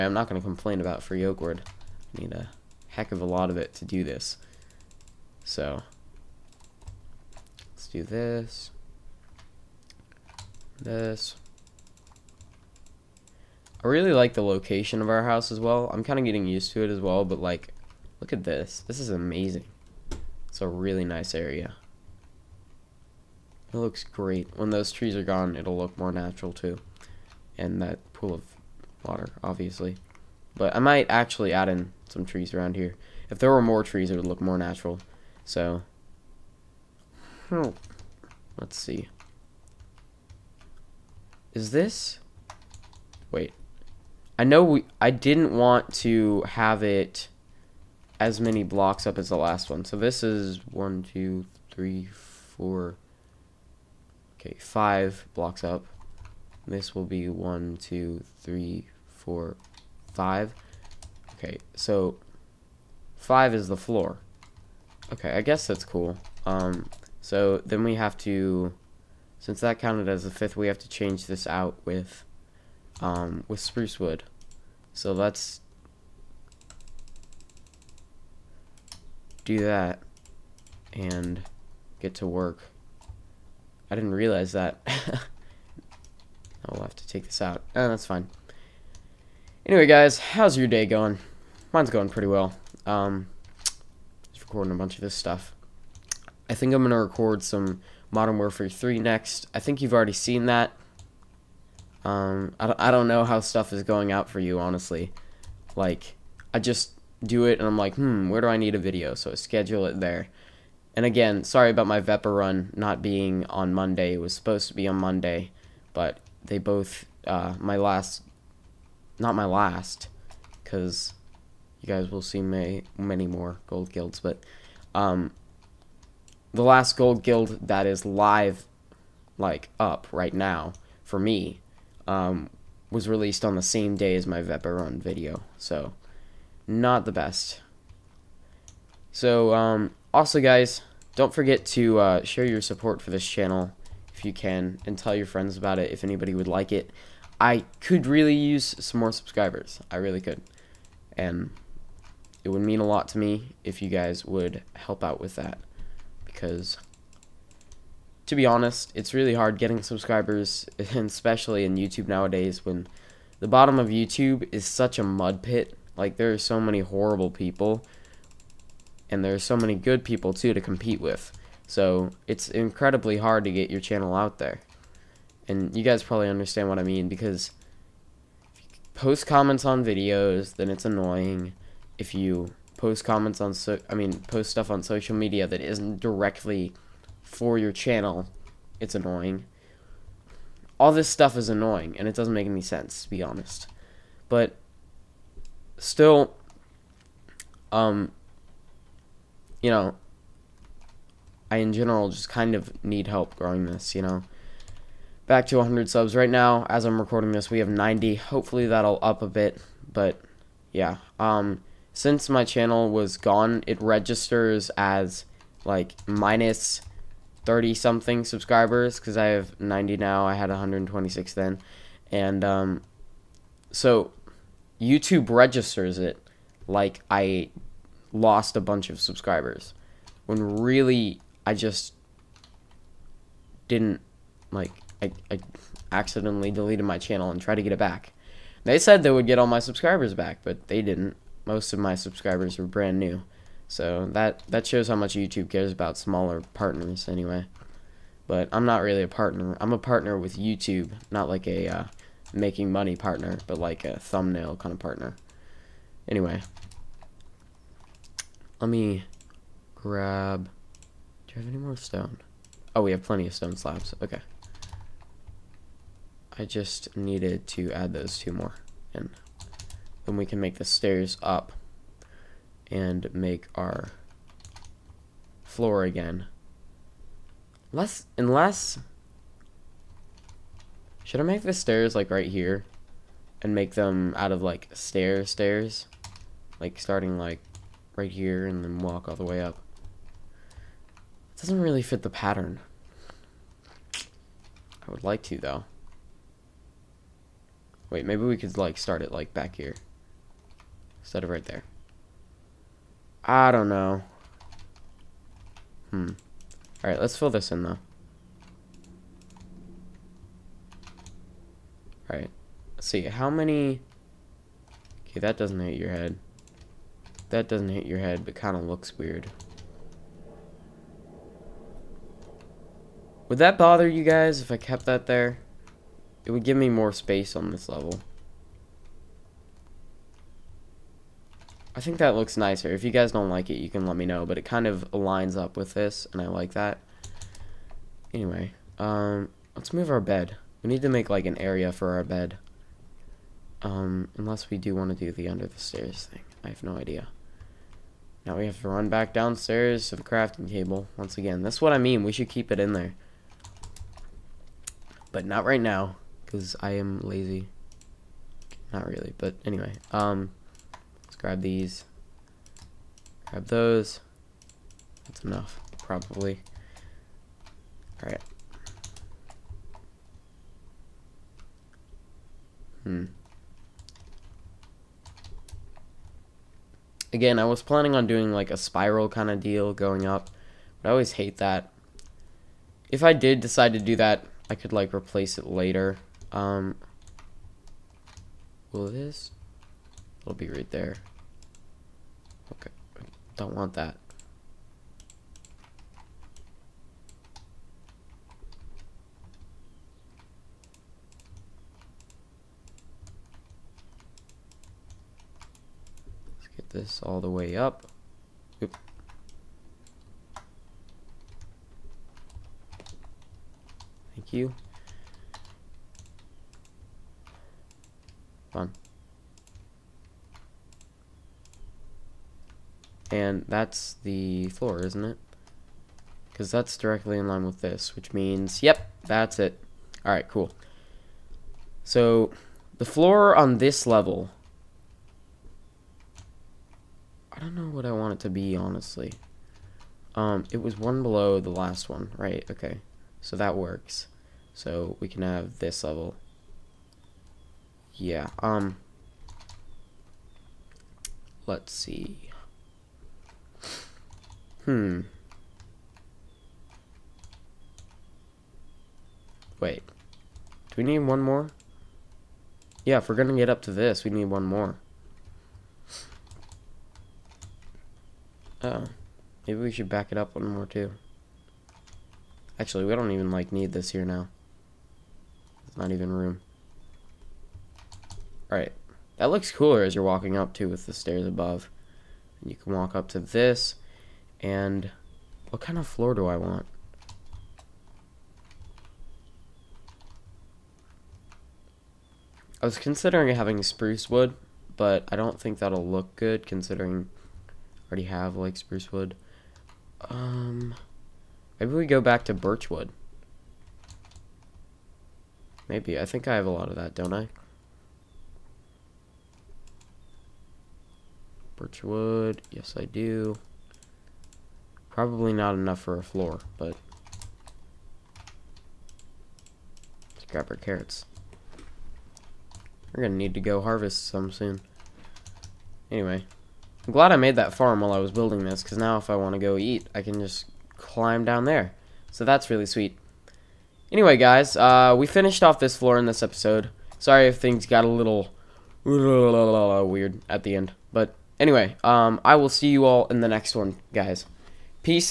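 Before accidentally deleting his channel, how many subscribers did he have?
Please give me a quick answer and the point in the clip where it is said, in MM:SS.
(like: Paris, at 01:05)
126, at 03:40.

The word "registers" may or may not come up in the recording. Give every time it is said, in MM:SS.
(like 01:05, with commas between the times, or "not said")
03:33, 03:45.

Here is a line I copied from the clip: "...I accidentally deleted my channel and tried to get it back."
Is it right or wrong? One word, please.
right.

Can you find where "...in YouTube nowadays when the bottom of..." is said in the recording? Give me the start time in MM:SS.
02:41.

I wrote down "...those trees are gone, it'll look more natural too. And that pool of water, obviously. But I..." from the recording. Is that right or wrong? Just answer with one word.
right.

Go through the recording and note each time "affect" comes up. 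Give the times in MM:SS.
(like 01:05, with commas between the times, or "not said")
not said.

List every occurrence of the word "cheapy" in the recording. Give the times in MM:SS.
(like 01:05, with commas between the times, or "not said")
not said.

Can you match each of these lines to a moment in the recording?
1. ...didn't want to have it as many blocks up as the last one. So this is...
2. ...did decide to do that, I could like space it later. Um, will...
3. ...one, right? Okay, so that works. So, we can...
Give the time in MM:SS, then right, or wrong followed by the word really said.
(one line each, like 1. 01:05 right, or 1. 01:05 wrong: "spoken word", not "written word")
1. 00:45 right
2. 06:23 wrong: "replace", not "space"
3. 07:21 right.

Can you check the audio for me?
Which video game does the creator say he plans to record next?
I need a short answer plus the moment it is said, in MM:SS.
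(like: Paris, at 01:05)
Modern Warfare 3, at 01:38.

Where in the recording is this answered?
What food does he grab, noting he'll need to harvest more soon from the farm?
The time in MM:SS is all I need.
08:40.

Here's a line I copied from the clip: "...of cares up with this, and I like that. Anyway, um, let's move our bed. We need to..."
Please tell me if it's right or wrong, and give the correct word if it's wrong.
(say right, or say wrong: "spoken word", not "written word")
wrong: "lines", not "cares".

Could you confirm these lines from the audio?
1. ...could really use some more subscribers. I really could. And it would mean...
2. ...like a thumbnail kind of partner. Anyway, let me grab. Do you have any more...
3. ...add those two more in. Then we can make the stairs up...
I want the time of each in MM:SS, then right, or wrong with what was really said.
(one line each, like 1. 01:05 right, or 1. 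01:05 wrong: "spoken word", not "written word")
1. 02:27 right
2. 04:13 right
3. 04:27 right.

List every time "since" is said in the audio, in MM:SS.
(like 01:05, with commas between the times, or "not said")
01:09, 03:31.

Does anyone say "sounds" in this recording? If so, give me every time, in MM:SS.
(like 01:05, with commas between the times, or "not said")
not said.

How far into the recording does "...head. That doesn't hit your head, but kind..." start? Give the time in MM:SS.
05:15.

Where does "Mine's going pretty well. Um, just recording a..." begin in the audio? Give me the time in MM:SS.
01:31.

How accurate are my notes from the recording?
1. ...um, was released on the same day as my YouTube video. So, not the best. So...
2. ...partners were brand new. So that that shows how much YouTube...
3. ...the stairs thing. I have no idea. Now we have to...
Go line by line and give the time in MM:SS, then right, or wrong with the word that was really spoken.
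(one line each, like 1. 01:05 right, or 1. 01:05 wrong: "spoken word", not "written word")
1. 02:12 wrong: "Vepa", not "YouTube"
2. 04:01 wrong: "subscribers", not "partners"
3. 05:45 right.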